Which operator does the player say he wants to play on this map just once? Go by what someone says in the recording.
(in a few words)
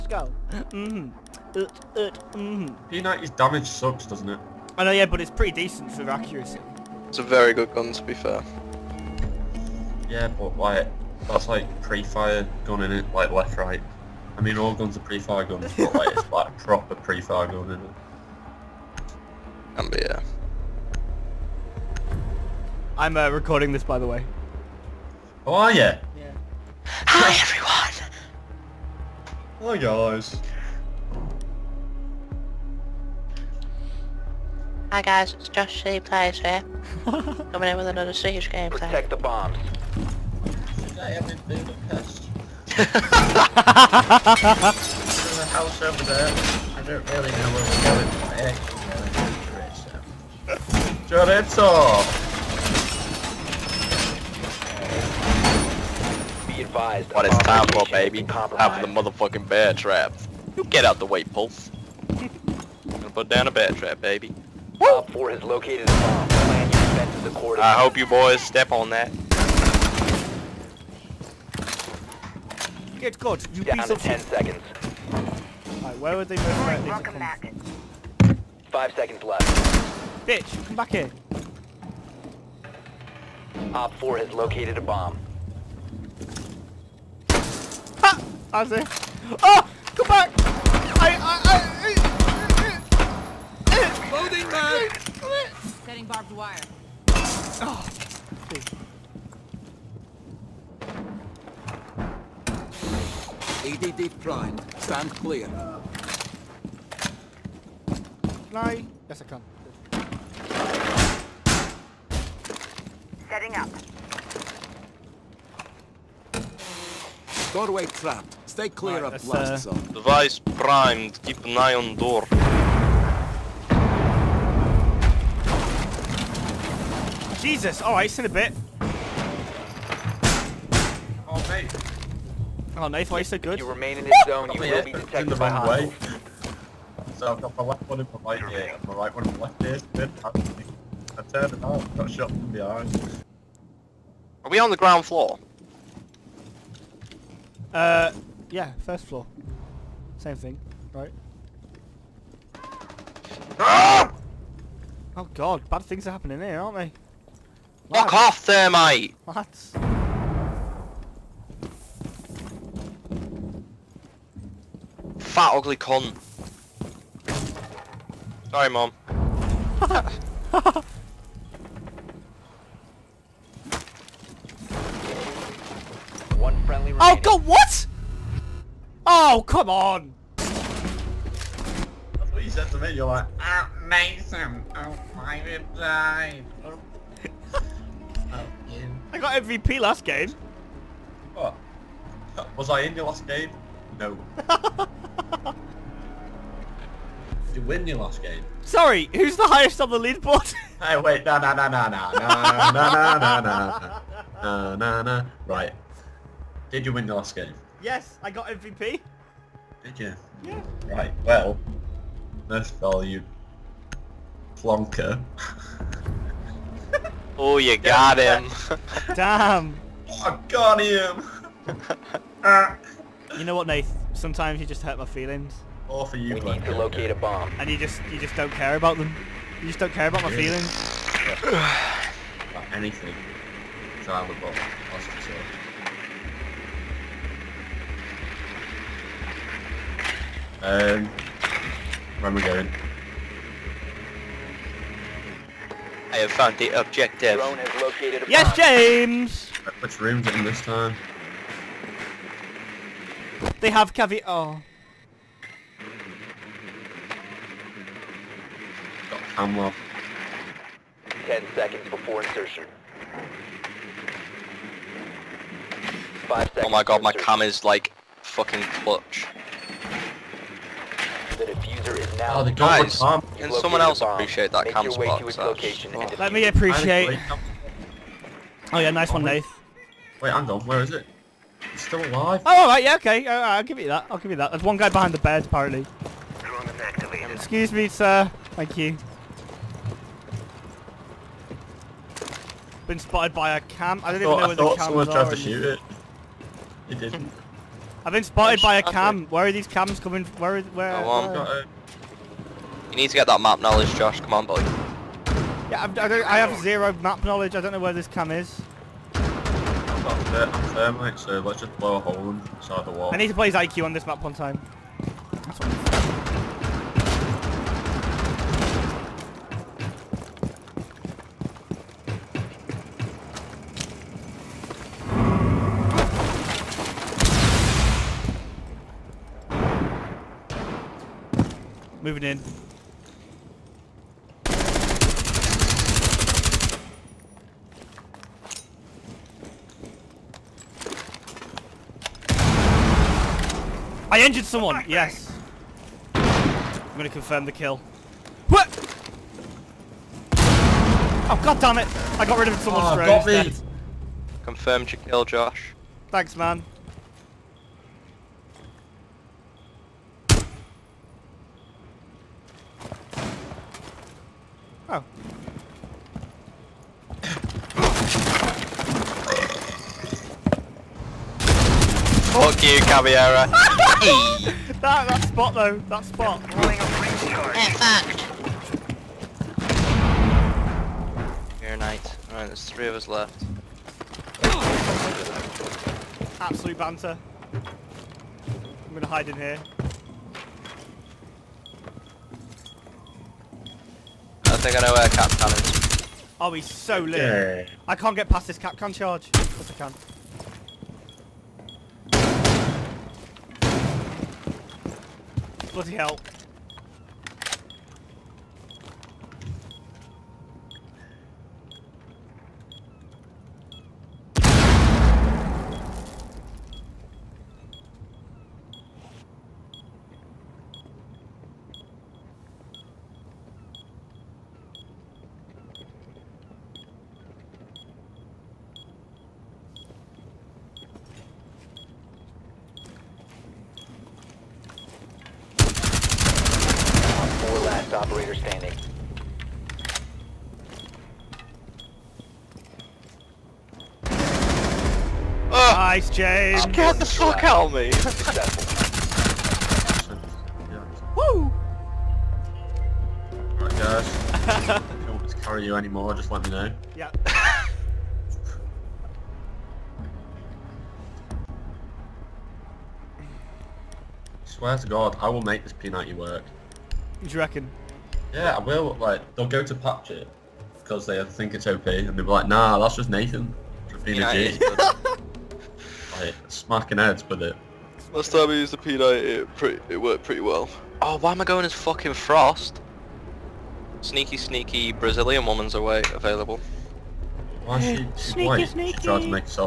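IQ.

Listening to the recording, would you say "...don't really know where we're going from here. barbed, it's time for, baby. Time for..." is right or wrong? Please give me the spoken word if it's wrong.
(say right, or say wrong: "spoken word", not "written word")
wrong: "advised", not "barbed".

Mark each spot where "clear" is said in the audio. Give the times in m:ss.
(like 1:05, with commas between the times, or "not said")
1:45, 1:58.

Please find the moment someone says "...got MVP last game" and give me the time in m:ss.
3:09.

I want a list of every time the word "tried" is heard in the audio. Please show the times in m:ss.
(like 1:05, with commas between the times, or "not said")
4:55, 8:09.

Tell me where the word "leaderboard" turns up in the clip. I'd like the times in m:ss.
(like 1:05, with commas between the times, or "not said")
3:19.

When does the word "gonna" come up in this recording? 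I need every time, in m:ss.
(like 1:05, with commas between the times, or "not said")
1:02, 5:46, 6:28.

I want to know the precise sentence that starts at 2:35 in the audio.
Oh god, bad things are happening here, aren't they?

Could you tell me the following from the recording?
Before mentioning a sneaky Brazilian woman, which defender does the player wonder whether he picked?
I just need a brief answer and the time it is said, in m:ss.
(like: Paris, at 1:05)
Frost, at 8:02.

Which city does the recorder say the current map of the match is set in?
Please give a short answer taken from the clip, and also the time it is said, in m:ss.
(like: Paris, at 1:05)
Budapest, at 0:41.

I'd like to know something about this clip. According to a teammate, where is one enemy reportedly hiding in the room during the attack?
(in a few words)
behind the bed.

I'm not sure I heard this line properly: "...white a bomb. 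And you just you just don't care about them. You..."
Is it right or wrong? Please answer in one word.
wrong.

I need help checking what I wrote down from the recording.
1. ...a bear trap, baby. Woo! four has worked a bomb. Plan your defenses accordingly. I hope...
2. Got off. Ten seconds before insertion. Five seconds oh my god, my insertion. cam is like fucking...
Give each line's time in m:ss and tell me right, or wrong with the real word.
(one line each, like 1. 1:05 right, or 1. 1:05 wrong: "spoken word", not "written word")
1. 1:03 wrong: "located", not "worked"
2. 4:19 right.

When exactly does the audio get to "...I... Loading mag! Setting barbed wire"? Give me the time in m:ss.
1:33.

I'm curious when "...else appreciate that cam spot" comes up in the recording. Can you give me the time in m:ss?
4:33.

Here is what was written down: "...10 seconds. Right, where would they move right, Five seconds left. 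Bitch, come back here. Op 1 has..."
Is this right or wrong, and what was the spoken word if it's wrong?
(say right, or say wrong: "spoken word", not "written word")
wrong: "4", not "1".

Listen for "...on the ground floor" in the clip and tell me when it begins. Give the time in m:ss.
2:24.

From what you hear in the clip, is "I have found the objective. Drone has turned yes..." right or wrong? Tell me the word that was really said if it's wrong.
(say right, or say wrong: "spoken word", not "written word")
wrong: "located", not "turned".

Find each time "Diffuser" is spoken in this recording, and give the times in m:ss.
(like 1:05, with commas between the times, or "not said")
4:31.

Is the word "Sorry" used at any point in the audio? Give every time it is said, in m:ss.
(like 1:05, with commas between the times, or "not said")
2:48, 3:18.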